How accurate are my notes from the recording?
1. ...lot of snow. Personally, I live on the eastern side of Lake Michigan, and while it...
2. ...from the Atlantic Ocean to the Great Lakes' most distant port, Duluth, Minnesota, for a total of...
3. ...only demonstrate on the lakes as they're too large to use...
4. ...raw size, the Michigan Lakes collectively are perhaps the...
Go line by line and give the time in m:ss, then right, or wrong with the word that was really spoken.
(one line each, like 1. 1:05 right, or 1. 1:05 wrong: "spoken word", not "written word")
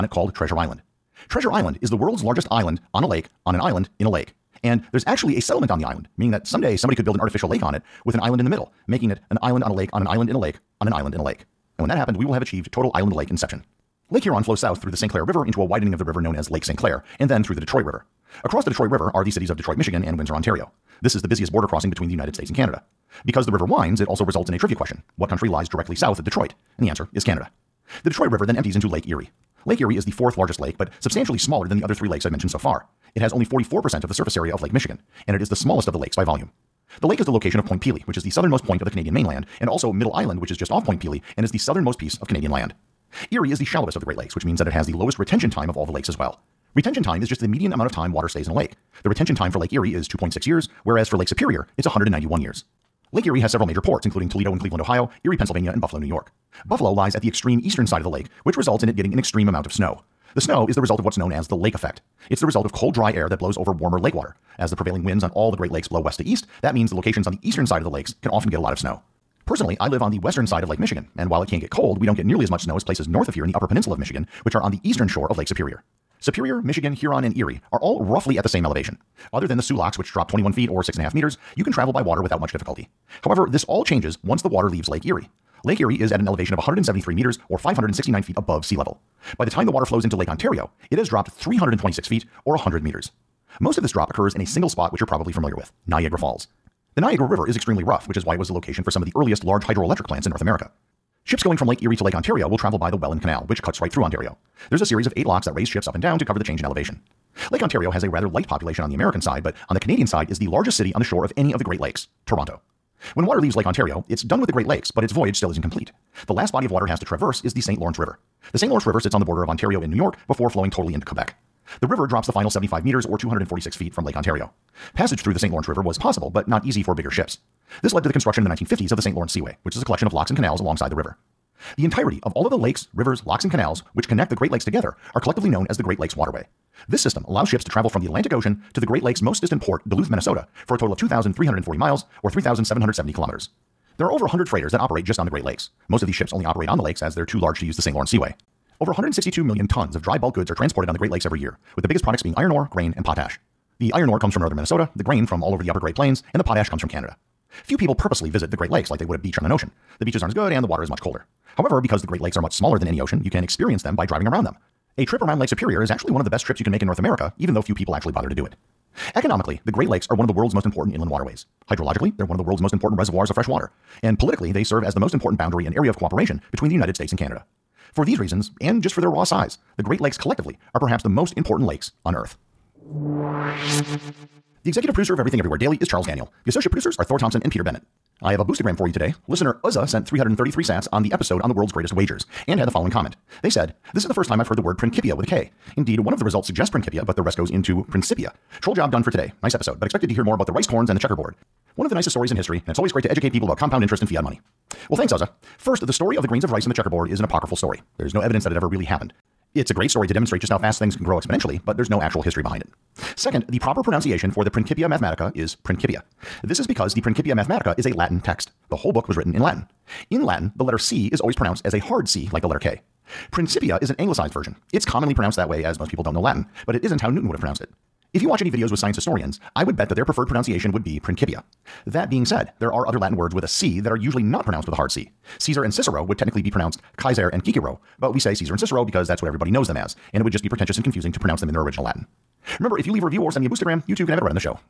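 1. 1:08 wrong: "western", not "eastern"
2. 2:17 right
3. 2:26 wrong: "operate", not "demonstrate"
4. 2:59 wrong: "Great", not "Michigan".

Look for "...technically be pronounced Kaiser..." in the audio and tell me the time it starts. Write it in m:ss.
3:56.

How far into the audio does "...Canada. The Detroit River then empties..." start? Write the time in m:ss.
0:27.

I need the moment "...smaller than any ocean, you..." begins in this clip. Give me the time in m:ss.
2:42.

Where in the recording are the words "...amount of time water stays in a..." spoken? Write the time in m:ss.
0:47.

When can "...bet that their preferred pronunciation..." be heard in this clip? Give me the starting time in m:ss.
3:49.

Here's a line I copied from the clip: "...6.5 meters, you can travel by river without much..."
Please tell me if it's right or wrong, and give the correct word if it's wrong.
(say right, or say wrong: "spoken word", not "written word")
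wrong: "water", not "river".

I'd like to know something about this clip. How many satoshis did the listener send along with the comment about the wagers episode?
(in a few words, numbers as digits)
333.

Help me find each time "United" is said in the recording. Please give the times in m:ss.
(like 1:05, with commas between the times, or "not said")
0:22, 2:56.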